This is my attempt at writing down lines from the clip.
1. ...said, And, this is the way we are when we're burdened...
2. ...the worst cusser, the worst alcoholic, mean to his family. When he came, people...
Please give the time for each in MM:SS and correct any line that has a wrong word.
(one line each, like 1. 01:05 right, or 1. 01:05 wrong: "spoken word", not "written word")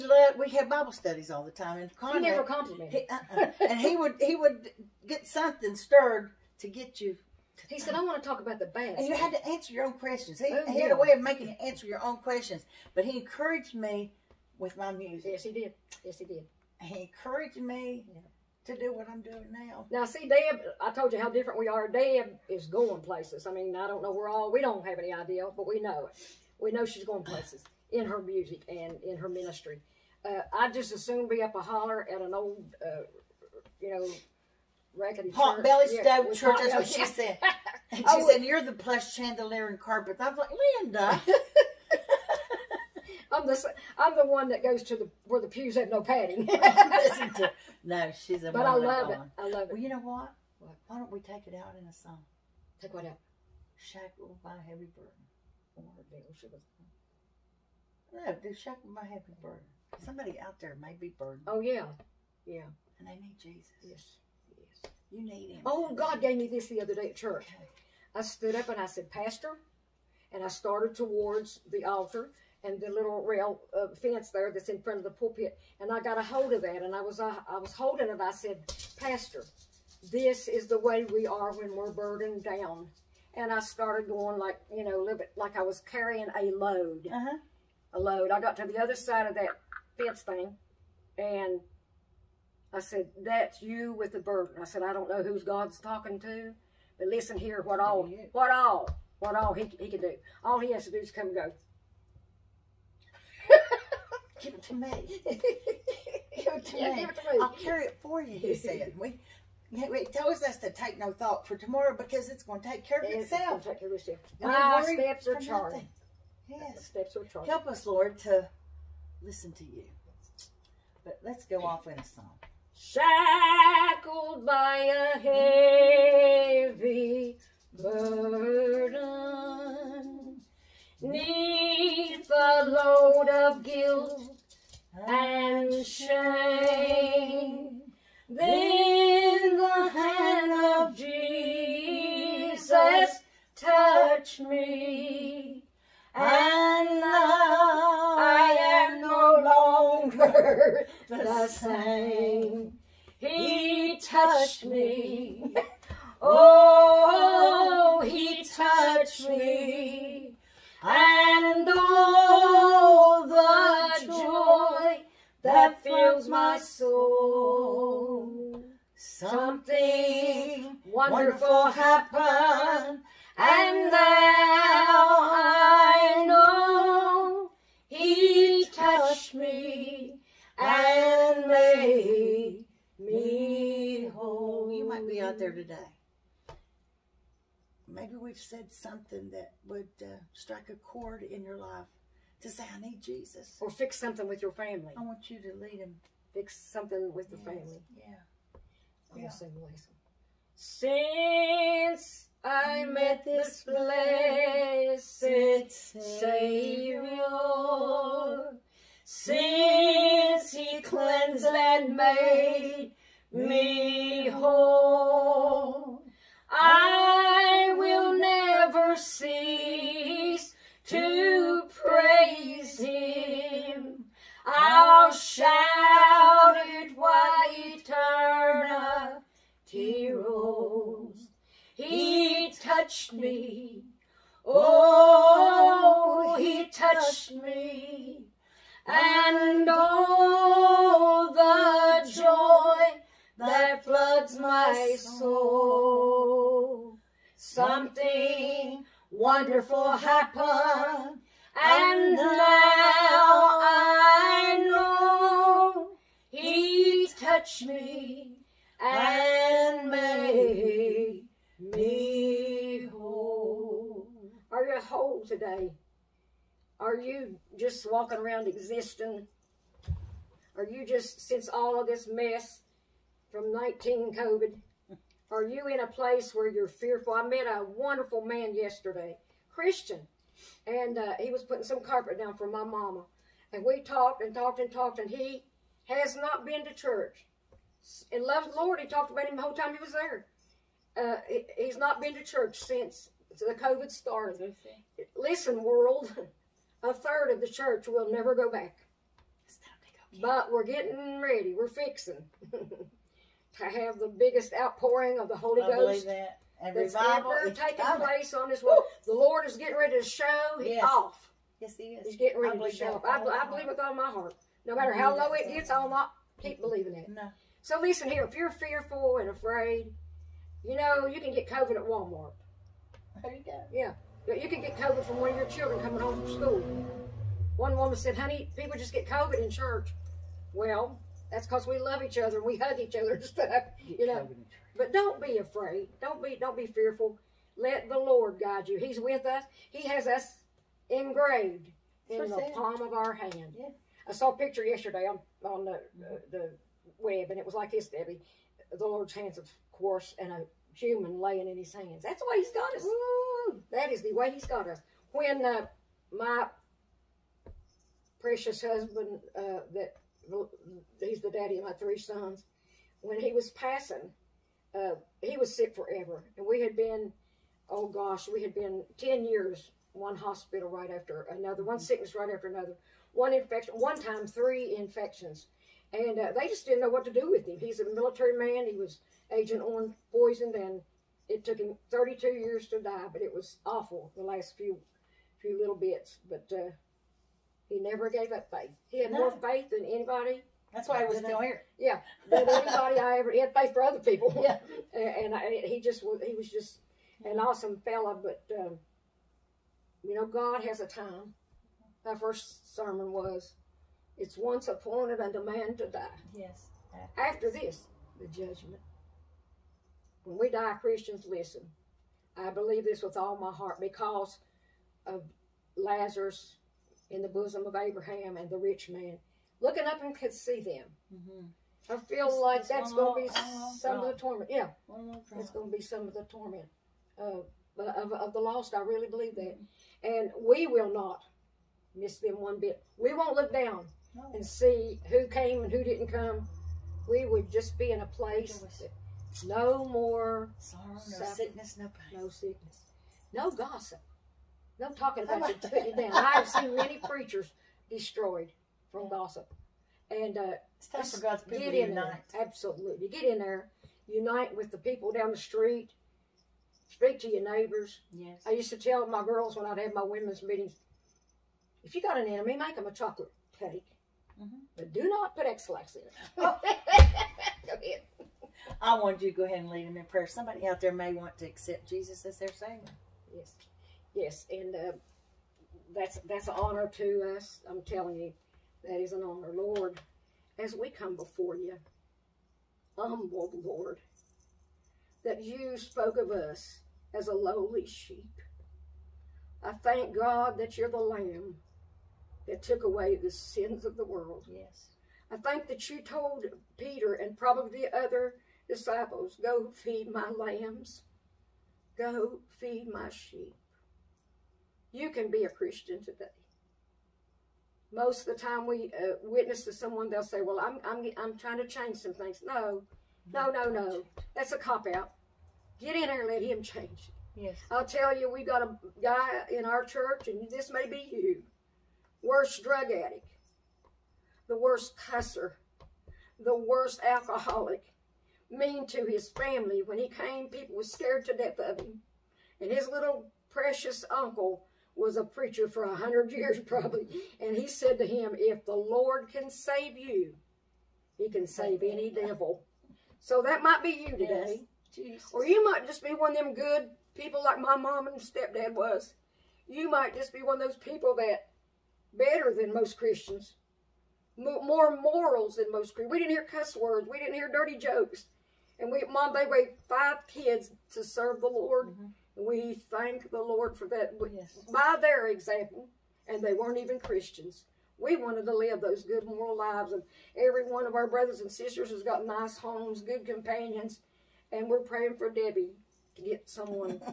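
1. 01:18 wrong: "Pastor", not "And"
2. 08:44 right.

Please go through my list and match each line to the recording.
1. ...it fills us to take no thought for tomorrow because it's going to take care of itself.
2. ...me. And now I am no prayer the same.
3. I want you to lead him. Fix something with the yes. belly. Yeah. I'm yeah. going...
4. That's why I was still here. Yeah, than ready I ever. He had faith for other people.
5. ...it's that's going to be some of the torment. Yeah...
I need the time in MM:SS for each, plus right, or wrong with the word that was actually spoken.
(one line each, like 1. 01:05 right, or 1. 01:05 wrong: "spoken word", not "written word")
1. 01:49 wrong: "tells", not "fills"
2. 02:24 wrong: "longer", not "prayer"
3. 03:14 wrong: "family", not "belly"
4. 06:30 wrong: "anybody", not "ready"
5. 07:02 right.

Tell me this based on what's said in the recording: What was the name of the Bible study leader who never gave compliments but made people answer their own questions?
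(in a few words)
Conrad.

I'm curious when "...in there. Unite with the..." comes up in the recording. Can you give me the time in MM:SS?
07:33.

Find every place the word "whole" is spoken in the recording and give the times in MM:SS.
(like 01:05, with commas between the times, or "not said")
03:04, 03:34, 04:49.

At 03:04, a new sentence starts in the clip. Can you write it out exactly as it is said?
You might be out there today.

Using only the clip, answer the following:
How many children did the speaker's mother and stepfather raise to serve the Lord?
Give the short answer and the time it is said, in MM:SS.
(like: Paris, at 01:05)
5, at 09:19.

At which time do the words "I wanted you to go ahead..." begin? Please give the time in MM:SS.
07:48.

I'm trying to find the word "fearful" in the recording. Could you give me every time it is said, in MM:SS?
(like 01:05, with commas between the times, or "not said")
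04:36, 05:18, 05:36.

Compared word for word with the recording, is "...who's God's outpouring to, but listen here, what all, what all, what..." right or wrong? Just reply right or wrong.
wrong.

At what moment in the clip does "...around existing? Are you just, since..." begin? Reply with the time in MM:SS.
04:28.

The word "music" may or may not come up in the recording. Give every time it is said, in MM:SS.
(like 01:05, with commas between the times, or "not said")
00:15, 00:28.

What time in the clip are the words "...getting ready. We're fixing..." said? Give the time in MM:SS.
05:00.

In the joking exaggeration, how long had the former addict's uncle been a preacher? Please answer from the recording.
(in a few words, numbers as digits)
100 years.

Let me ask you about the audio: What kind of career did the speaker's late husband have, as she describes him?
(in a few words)
Military.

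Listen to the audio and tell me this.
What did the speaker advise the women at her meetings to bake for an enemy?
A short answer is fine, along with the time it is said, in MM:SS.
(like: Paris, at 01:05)
Chocolate cake, at 07:42.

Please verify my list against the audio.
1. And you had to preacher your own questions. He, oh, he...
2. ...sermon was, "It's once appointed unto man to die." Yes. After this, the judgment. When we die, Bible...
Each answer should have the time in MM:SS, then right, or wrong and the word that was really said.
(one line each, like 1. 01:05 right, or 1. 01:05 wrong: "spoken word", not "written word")
1. 00:08 wrong: "answer", not "preacher"
2. 06:42 wrong: "Christians", not "Bible".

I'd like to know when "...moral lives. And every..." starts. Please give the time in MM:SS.
09:29.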